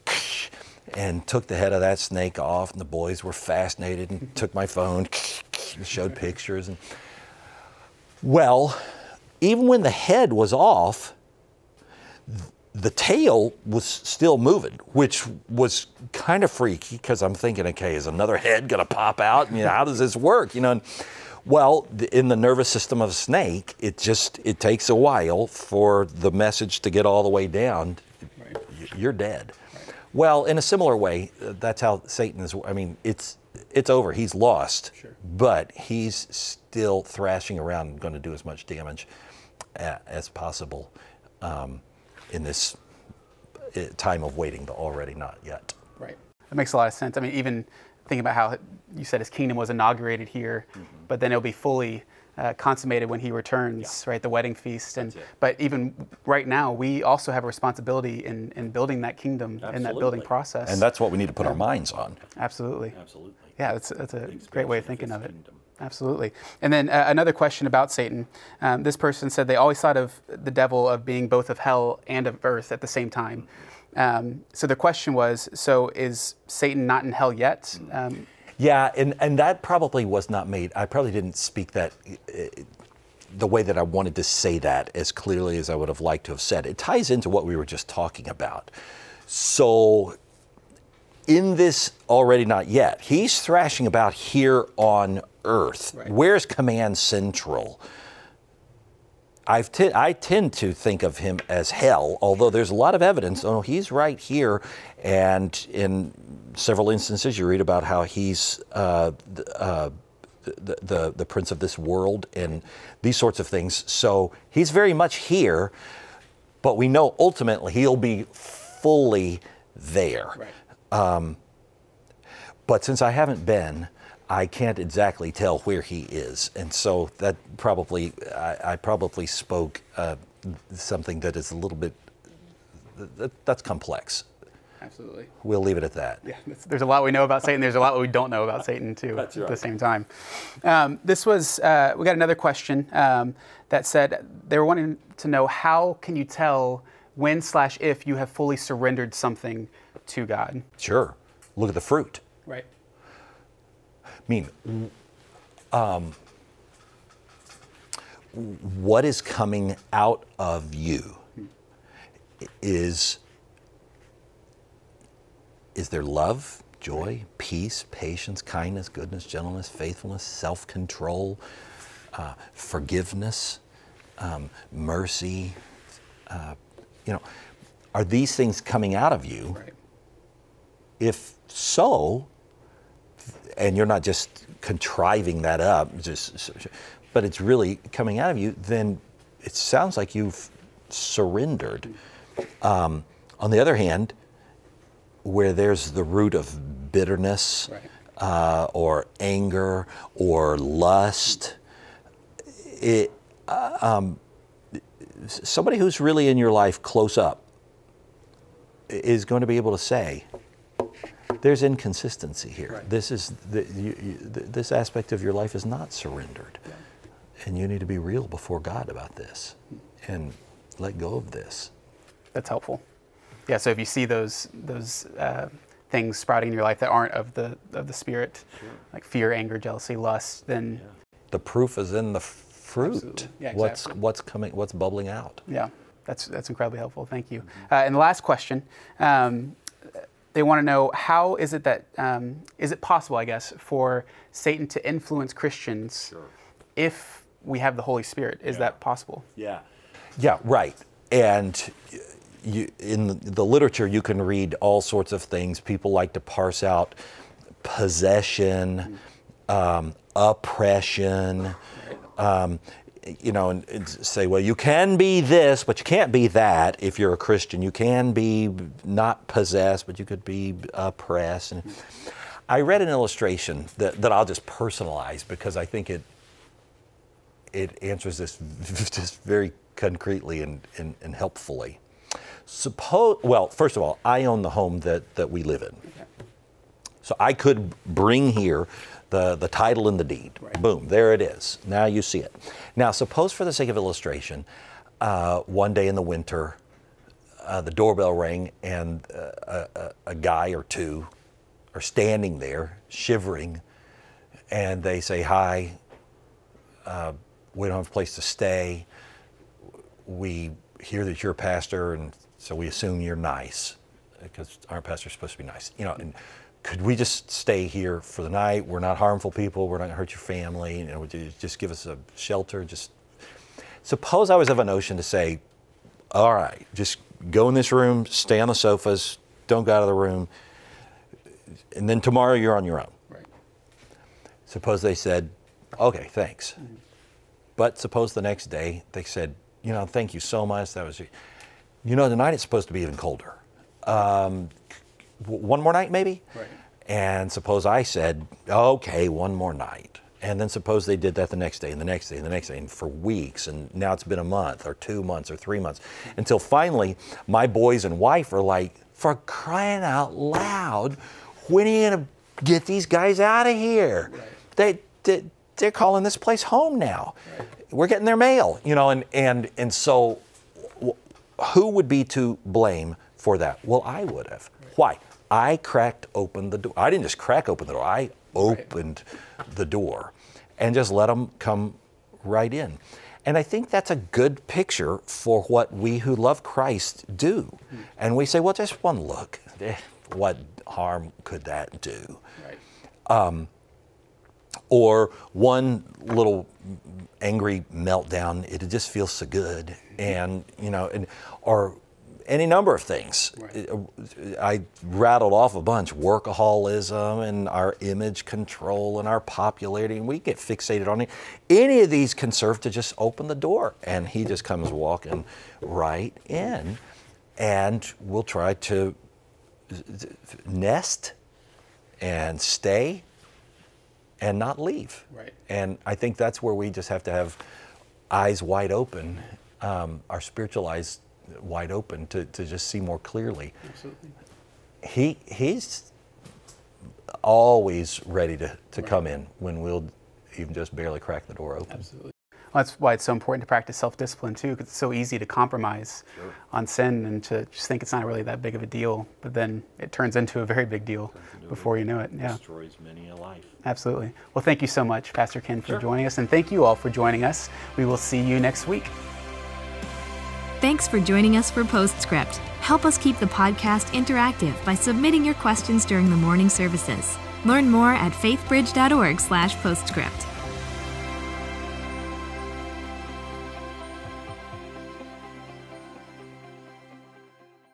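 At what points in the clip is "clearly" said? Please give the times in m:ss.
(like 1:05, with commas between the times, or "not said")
1:25, 7:12.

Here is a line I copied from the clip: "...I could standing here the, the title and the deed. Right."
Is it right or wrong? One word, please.
wrong.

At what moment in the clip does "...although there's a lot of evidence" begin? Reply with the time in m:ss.
1:42.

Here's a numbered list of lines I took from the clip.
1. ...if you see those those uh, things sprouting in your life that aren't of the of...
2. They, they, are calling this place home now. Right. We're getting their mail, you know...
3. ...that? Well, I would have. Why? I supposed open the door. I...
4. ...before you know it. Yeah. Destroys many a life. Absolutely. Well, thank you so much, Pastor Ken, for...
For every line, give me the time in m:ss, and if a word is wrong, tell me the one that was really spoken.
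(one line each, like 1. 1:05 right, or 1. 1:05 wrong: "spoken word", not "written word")
1. 3:43 right
2. 6:05 right
3. 6:13 wrong: "cracked", not "supposed"
4. 7:31 right.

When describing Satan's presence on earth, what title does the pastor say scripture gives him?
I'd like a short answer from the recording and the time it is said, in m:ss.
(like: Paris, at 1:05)
Prince of this world, at 1:51.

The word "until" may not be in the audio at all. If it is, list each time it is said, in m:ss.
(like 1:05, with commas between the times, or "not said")
5:56.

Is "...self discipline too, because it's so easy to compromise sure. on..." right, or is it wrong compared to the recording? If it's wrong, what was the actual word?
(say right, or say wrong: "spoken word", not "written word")
right.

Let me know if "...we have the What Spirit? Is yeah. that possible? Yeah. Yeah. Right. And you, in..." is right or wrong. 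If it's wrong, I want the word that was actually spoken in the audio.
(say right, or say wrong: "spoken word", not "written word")
wrong: "Holy", not "What".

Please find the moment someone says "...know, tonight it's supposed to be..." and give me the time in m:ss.
5:41.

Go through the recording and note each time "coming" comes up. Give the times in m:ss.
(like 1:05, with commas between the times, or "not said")
2:39, 2:58, 3:07, 3:54.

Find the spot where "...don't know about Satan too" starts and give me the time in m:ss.
2:18.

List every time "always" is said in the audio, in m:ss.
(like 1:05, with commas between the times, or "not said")
1:09, 7:17.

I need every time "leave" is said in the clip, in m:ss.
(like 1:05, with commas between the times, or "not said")
2:15, 7:04.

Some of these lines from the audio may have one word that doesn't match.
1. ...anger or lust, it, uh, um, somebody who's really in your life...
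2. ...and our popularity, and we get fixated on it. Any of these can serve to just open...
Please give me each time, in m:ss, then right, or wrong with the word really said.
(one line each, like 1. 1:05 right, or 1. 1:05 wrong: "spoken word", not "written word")
1. 3:19 right
2. 6:48 right.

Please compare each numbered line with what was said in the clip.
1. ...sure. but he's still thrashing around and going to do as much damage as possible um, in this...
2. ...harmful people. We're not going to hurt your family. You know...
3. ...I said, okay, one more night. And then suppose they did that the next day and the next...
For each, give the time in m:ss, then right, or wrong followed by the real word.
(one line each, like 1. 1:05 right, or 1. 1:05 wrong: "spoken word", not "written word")
1. 0:34 right
2. 5:18 right
3. 5:47 right.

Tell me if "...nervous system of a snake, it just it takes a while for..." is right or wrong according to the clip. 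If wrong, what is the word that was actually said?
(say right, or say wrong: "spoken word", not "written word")
right.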